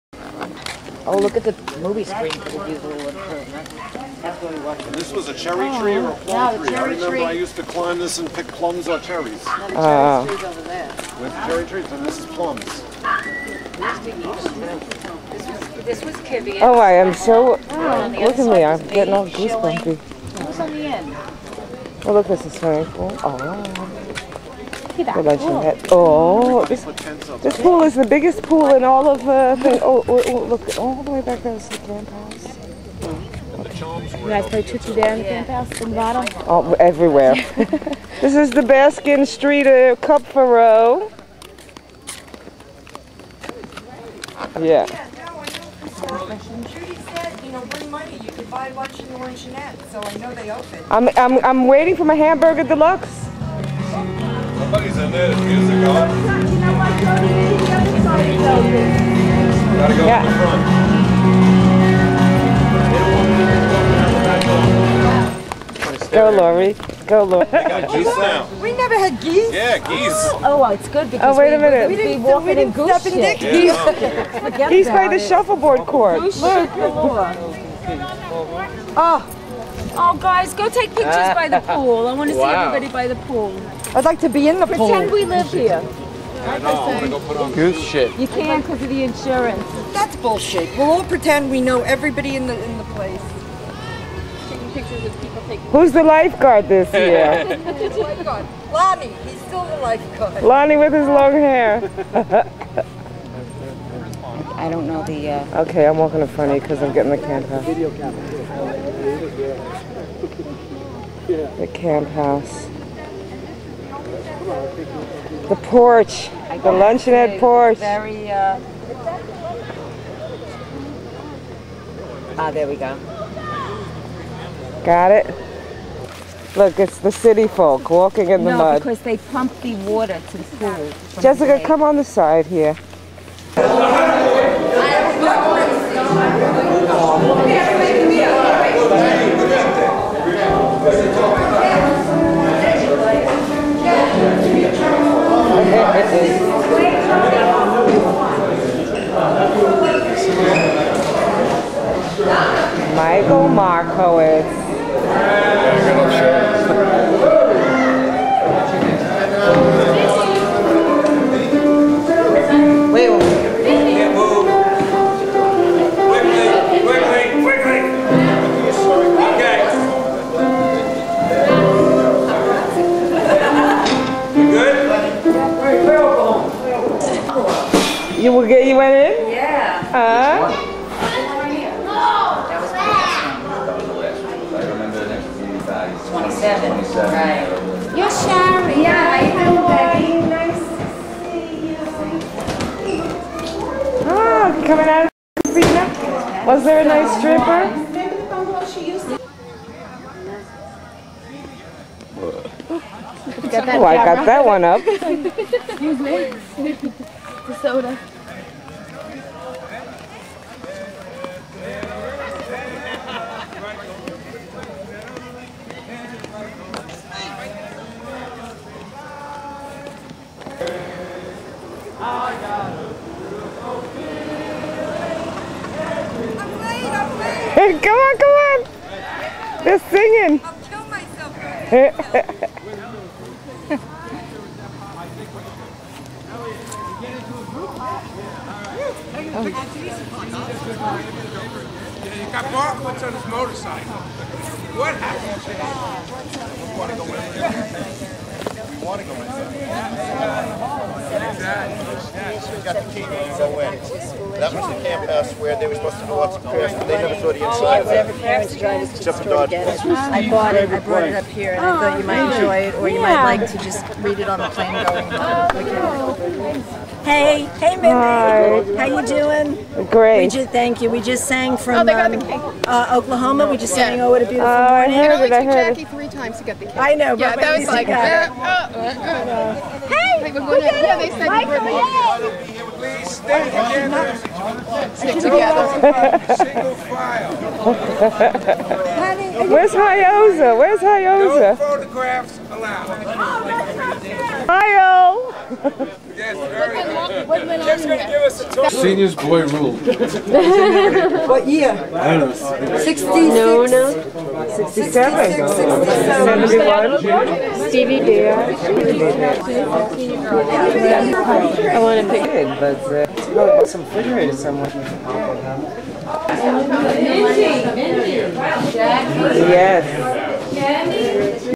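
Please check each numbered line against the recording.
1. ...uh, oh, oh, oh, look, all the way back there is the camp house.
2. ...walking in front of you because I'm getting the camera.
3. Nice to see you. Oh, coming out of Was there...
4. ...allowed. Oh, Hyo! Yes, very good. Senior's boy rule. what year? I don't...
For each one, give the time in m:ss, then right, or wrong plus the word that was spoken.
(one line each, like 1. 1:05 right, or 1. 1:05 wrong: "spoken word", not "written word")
1. 0:29 right
2. 1:45 right
3. 3:10 right
4. 4:52 right.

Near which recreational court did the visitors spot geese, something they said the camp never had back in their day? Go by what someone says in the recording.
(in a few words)
shuffleboard court.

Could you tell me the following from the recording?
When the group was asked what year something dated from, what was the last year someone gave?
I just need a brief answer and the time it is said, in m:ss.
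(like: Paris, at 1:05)
71, at 5:05.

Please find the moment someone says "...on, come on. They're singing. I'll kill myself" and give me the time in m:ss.
3:47.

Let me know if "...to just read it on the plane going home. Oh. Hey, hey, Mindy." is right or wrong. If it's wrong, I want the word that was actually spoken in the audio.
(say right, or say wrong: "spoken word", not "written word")
right.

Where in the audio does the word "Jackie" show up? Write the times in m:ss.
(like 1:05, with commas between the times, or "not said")
4:35, 5:18.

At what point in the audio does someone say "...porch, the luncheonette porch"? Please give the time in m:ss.
1:55.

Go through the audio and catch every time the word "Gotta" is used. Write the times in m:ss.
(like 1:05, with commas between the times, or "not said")
0:55.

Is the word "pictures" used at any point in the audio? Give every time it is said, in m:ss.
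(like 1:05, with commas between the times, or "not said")
1:20, 1:34.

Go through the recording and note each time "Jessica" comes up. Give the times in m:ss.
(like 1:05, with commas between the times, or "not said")
2:11.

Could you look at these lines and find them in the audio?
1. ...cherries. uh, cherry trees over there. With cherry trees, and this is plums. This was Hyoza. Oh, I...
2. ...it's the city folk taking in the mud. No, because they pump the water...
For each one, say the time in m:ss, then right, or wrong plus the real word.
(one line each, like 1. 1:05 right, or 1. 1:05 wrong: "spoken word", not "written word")
1. 0:08 wrong: "Kivian", not "Hyoza"
2. 2:06 wrong: "walking", not "taking".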